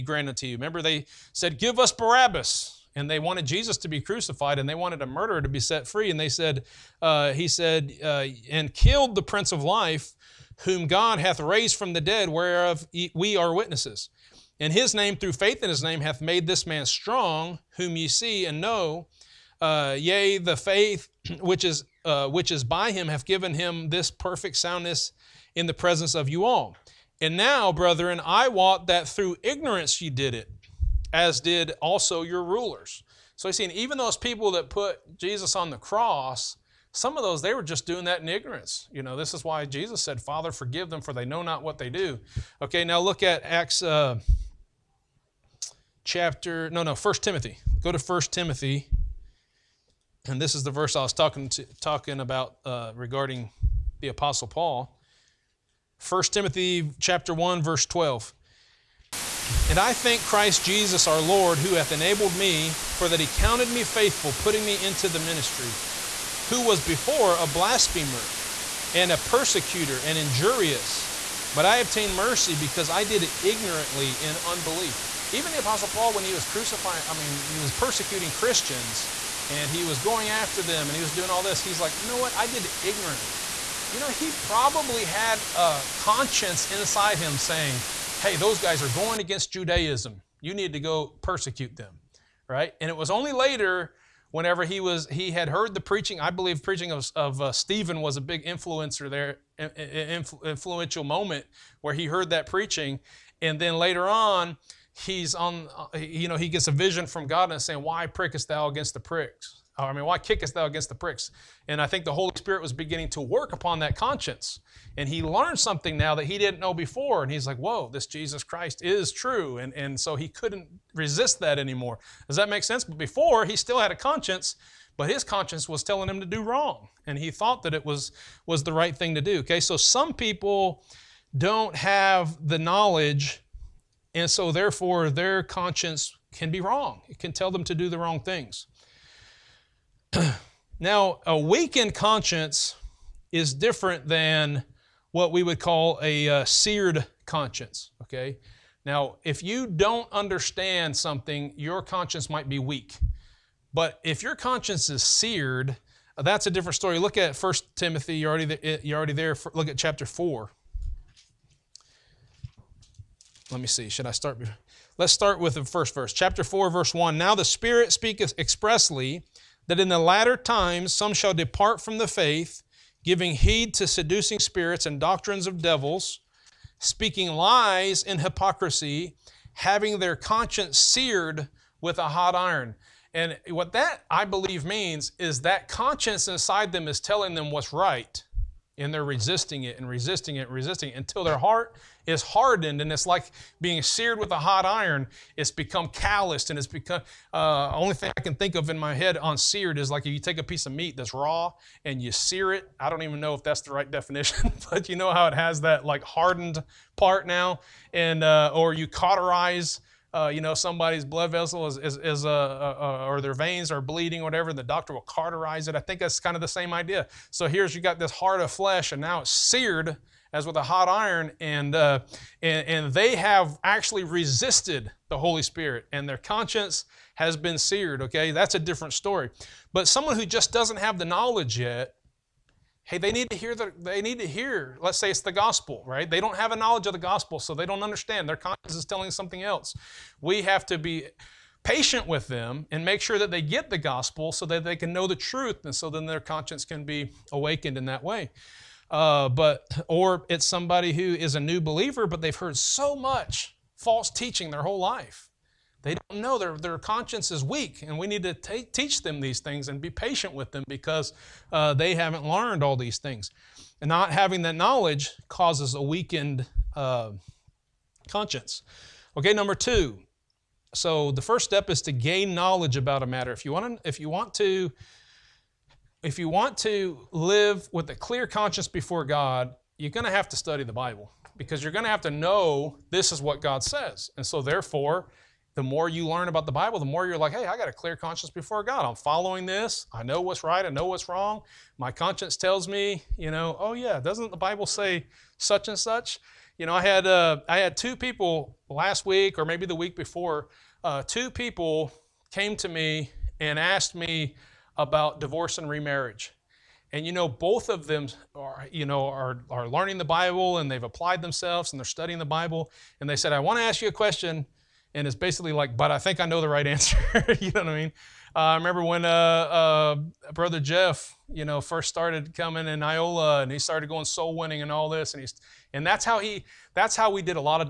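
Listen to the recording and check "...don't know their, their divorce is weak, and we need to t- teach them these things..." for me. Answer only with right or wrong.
wrong.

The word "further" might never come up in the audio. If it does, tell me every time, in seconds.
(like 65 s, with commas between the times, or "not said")
not said.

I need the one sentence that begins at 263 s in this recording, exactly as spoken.
And not having that knowledge causes a weakened uh, conscience.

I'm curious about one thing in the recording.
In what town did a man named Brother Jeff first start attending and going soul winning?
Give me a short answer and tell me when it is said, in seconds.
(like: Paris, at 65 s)
Iola, at 322 s.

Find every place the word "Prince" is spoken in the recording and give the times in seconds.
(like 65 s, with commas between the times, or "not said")
9 s.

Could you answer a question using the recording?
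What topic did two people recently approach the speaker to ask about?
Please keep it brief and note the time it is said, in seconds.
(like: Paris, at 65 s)
Divorce and remarriage, at 305 s.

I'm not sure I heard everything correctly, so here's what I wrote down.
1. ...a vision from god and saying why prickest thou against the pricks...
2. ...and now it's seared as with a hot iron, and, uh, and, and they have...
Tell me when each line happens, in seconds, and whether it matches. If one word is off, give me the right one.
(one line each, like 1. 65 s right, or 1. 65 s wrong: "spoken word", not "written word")
1. 106 s right
2. 218 s right.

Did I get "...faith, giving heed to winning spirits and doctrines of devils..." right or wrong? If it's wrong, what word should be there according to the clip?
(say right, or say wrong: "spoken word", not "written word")
wrong: "seducing", not "winning".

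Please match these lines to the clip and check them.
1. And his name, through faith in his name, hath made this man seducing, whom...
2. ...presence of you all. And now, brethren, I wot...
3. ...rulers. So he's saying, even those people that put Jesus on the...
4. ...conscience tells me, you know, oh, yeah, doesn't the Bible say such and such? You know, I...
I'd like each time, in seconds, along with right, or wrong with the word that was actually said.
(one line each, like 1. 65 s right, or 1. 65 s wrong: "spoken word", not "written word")
1. 14 s wrong: "strong", not "seducing"
2. 25 s right
3. 32 s right
4. 291 s right.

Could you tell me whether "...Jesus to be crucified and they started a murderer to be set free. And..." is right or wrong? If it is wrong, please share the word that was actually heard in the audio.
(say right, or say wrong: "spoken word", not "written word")
wrong: "wanted", not "started".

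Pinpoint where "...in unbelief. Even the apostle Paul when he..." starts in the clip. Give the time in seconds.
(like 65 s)
74 s.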